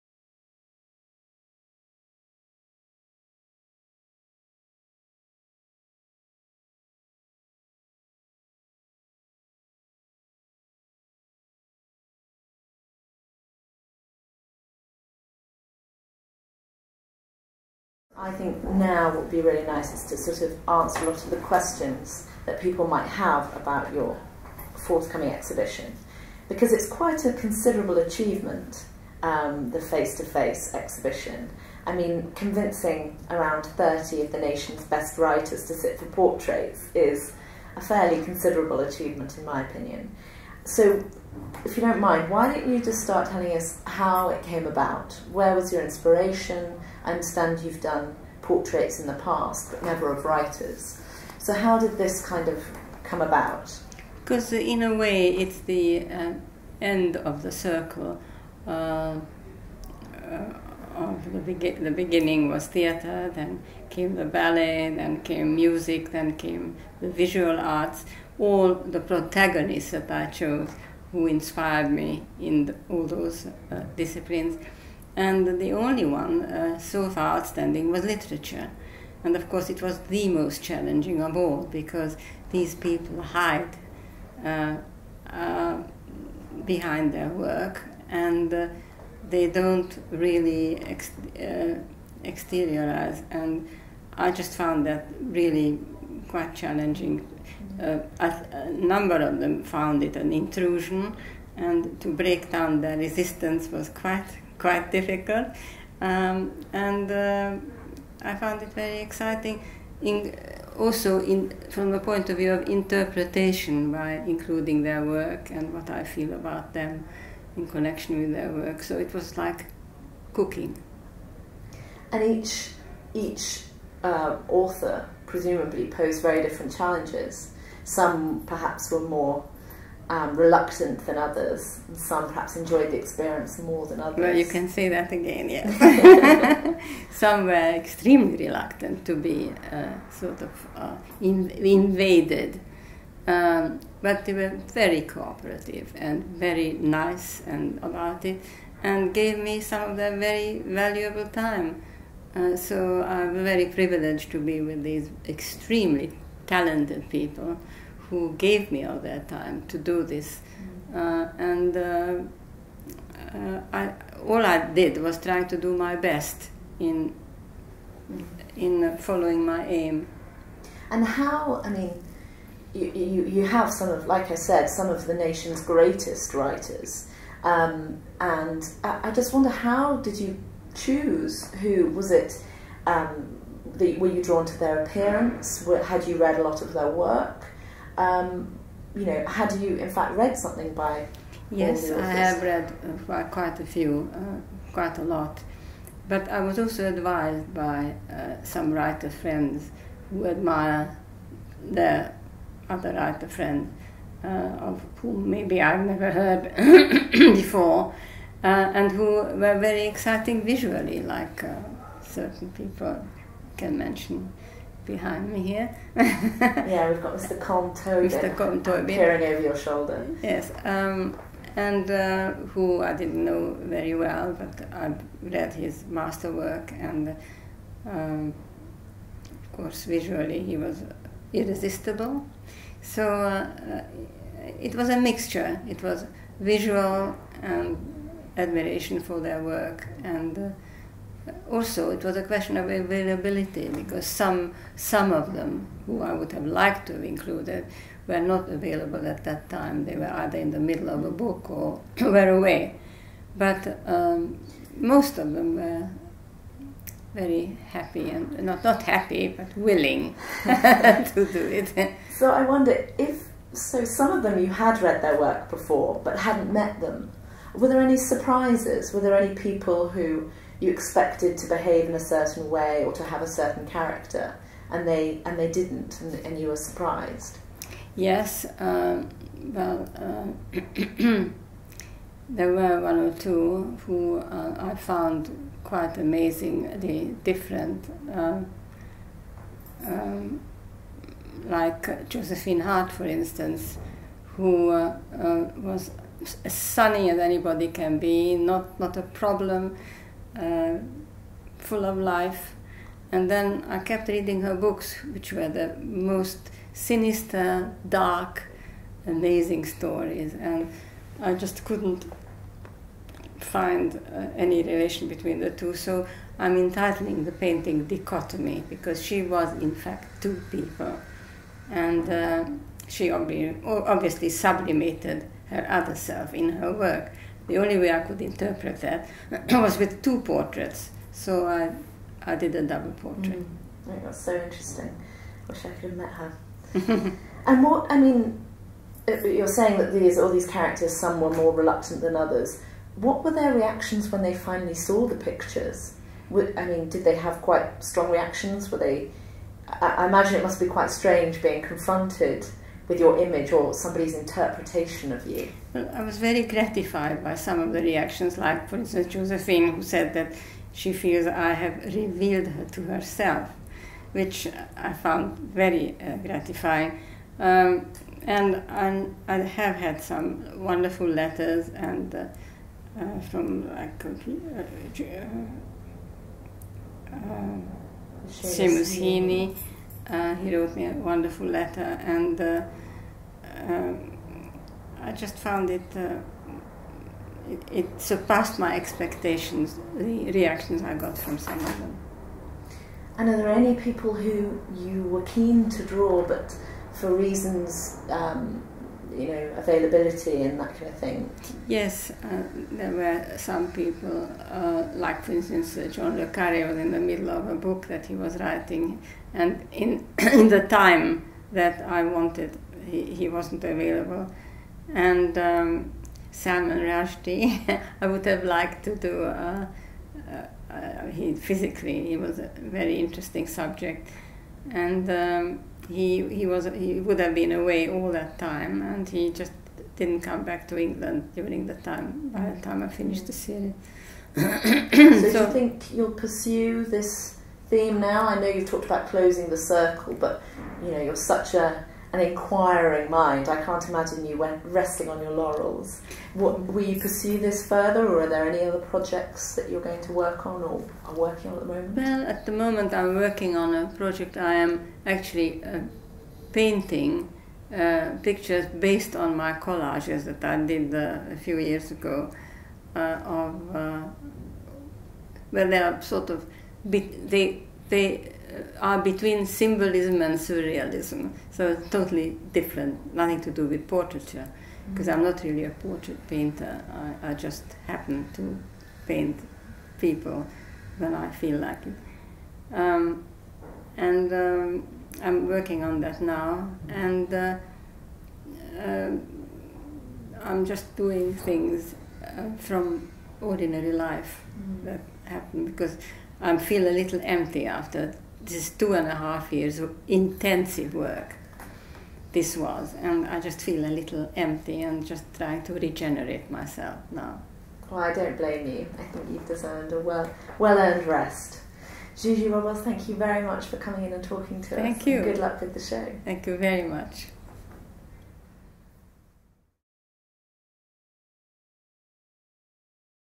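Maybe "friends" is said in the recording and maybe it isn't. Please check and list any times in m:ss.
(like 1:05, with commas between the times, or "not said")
3:19, 3:23.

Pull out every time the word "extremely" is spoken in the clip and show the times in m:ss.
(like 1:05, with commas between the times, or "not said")
2:17, 2:35.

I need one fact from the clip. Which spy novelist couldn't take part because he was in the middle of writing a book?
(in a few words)
John Le Carre.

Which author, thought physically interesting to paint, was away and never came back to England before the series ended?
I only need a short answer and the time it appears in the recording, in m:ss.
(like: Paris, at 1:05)
Salman Rushdie, at 6:56.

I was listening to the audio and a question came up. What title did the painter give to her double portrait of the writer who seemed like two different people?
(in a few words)
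Dichotomy.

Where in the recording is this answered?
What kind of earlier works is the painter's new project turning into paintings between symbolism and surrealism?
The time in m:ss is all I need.
7:39.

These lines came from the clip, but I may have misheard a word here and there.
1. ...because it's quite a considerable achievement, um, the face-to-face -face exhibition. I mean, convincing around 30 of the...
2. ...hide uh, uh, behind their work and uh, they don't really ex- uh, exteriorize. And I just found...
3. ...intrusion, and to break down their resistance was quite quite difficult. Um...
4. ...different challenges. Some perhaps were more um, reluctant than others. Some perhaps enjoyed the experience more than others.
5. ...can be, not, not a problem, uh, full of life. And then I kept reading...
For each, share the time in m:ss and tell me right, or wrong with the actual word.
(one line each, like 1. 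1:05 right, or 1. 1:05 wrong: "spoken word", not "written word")
1. 0:26 right
2. 1:23 right
3. 1:40 right
4. 2:06 right
5. 4:57 right.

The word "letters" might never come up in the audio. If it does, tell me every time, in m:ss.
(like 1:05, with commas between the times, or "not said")
6:11, 6:21.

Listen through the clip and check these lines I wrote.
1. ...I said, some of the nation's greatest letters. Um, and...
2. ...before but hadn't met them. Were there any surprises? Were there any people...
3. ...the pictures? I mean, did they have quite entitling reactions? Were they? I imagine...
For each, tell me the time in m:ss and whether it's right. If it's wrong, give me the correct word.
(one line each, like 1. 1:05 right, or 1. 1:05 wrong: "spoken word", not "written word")
1. 2:54 wrong: "writers", not "letters"
2. 4:25 right
3. 5:45 wrong: "strong", not "entitling".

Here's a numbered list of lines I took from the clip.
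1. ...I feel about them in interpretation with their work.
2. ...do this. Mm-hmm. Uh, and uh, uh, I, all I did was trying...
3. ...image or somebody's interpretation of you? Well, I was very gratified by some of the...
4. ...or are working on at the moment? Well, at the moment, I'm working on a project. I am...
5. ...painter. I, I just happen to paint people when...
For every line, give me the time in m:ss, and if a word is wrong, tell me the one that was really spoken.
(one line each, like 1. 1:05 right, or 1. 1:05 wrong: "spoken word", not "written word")
1. 1:55 wrong: "connection", not "interpretation"
2. 2:39 right
3. 5:53 right
4. 7:30 right
5. 7:56 right.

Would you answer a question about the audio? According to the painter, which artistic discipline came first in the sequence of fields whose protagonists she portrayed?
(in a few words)
Theater.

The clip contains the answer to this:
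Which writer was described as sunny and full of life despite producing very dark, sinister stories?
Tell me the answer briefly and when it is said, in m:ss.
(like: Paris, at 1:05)
Josephine Hart, at 4:52.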